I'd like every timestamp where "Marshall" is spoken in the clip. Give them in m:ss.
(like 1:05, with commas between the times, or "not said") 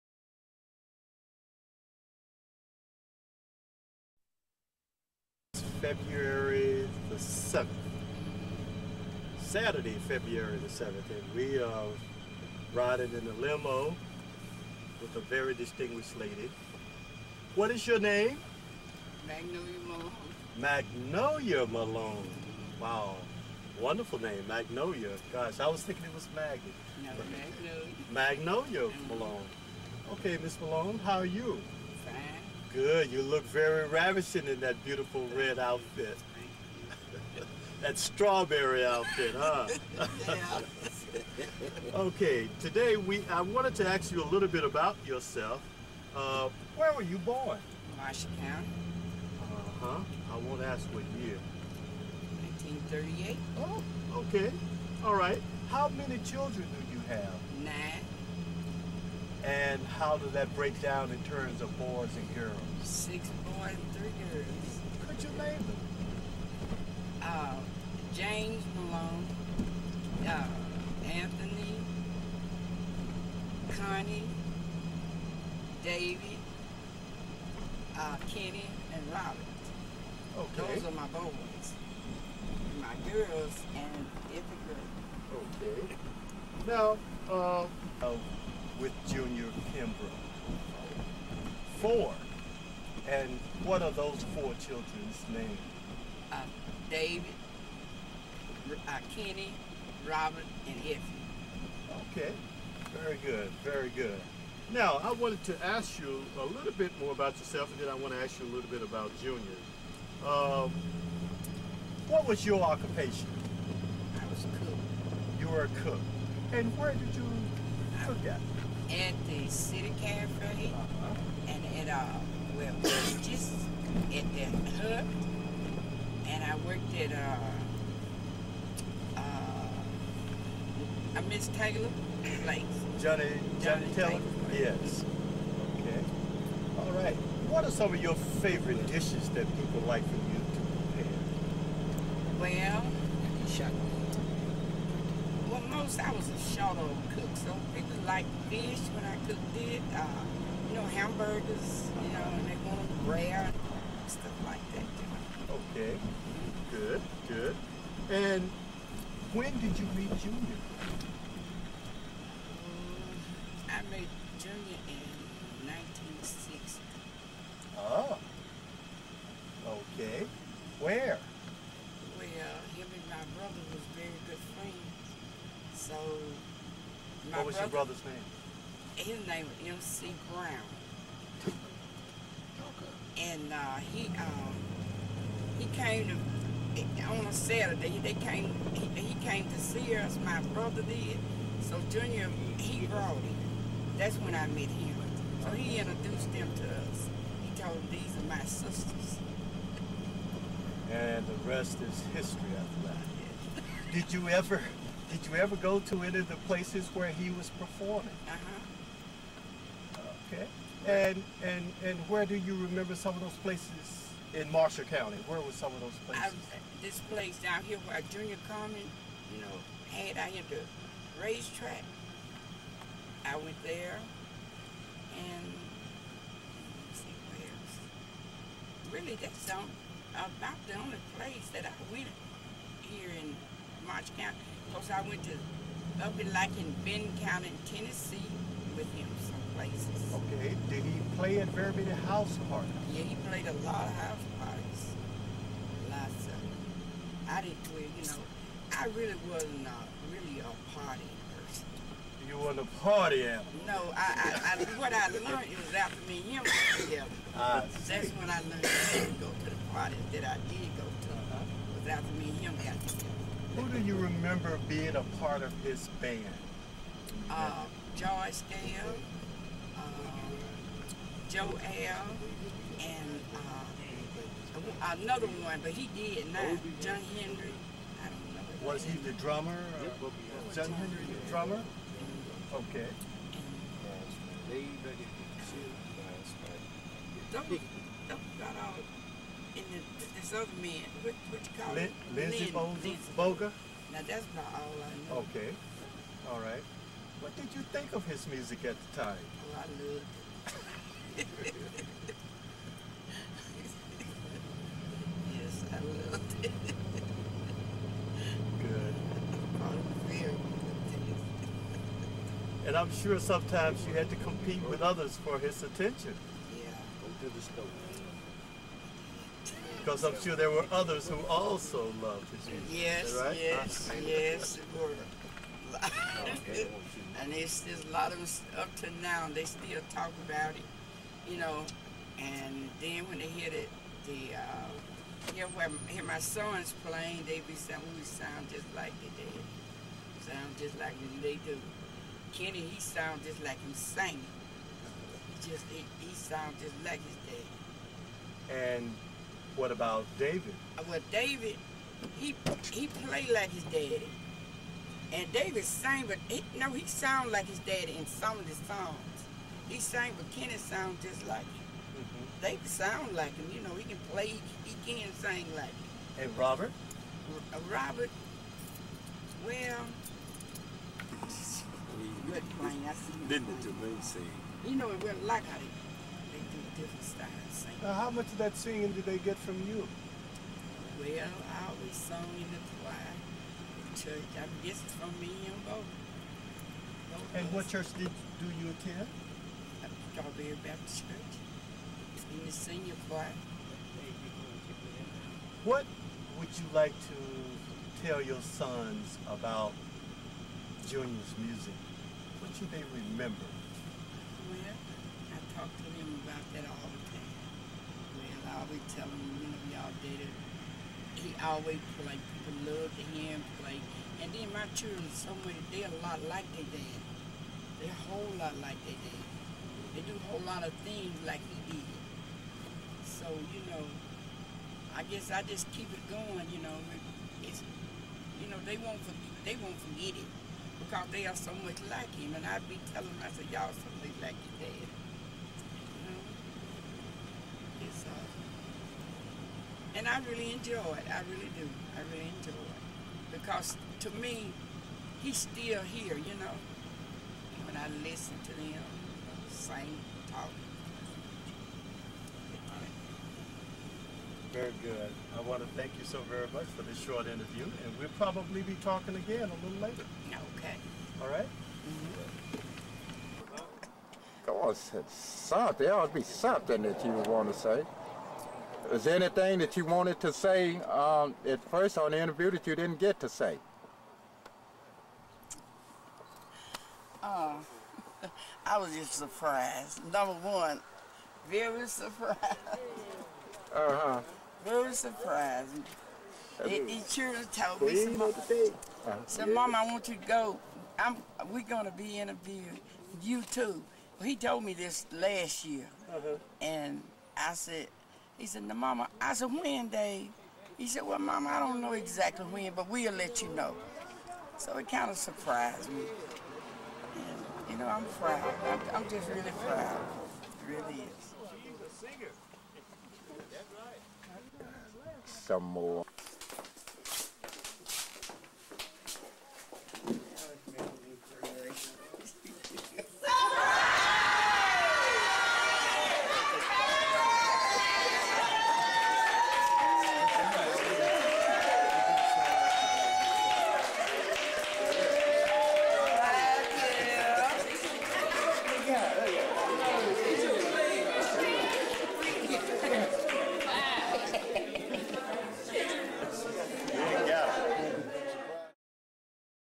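0:47, 3:34.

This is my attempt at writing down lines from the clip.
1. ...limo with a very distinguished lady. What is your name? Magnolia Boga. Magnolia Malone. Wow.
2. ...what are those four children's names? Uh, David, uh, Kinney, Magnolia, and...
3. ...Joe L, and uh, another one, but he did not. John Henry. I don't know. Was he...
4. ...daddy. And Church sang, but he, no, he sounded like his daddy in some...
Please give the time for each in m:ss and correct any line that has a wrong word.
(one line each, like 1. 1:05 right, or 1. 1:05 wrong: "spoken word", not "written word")
1. 0:13 wrong: "Malone", not "Boga"
2. 1:33 wrong: "Robin", not "Magnolia"
3. 4:31 right
4. 5:53 wrong: "David", not "Church".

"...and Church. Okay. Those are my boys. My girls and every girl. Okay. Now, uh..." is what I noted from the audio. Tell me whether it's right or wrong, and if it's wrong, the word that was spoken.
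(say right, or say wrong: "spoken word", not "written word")
wrong: "Robert", not "Church".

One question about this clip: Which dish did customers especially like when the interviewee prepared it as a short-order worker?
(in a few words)
Fish.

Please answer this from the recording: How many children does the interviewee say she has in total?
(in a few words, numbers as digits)
9.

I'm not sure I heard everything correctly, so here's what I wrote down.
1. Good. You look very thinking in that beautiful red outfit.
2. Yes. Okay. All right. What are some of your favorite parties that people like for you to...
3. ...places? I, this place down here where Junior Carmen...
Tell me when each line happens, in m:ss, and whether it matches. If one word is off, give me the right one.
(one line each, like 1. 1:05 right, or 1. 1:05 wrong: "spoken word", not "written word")
1. 0:32 wrong: "ravishing", not "thinking"
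2. 2:14 wrong: "dishes", not "parties"
3. 3:36 right.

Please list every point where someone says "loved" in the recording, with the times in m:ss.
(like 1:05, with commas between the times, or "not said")
4:59, 5:06, 5:22, 6:52.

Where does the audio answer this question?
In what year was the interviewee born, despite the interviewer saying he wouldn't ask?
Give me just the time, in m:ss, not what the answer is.
0:52.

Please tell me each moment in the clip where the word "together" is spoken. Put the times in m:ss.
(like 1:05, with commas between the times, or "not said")
4:16, 4:22.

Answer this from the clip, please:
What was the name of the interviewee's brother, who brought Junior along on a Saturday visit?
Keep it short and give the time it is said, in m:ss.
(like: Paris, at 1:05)
MC Brown, at 2:59.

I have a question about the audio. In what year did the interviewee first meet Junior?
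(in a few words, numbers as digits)
1960.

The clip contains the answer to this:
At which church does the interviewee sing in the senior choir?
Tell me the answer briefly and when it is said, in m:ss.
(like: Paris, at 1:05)
Strawberry Baptist Church, at 6:30.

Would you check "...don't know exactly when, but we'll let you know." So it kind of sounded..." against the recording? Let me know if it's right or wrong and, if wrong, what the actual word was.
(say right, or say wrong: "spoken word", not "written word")
wrong: "surprised", not "sounded".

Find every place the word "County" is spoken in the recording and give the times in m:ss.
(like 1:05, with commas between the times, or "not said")
0:48, 3:34, 3:57.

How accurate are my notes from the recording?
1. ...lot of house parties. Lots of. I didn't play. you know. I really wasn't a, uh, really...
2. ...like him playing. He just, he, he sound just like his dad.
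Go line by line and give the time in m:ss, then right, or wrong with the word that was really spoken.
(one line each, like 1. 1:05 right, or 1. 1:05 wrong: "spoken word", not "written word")
1. 4:03 right
2. 5:43 wrong: "singing", not "playing".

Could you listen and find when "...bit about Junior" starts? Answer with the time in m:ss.
1:48.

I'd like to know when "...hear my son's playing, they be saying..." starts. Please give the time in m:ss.
5:35.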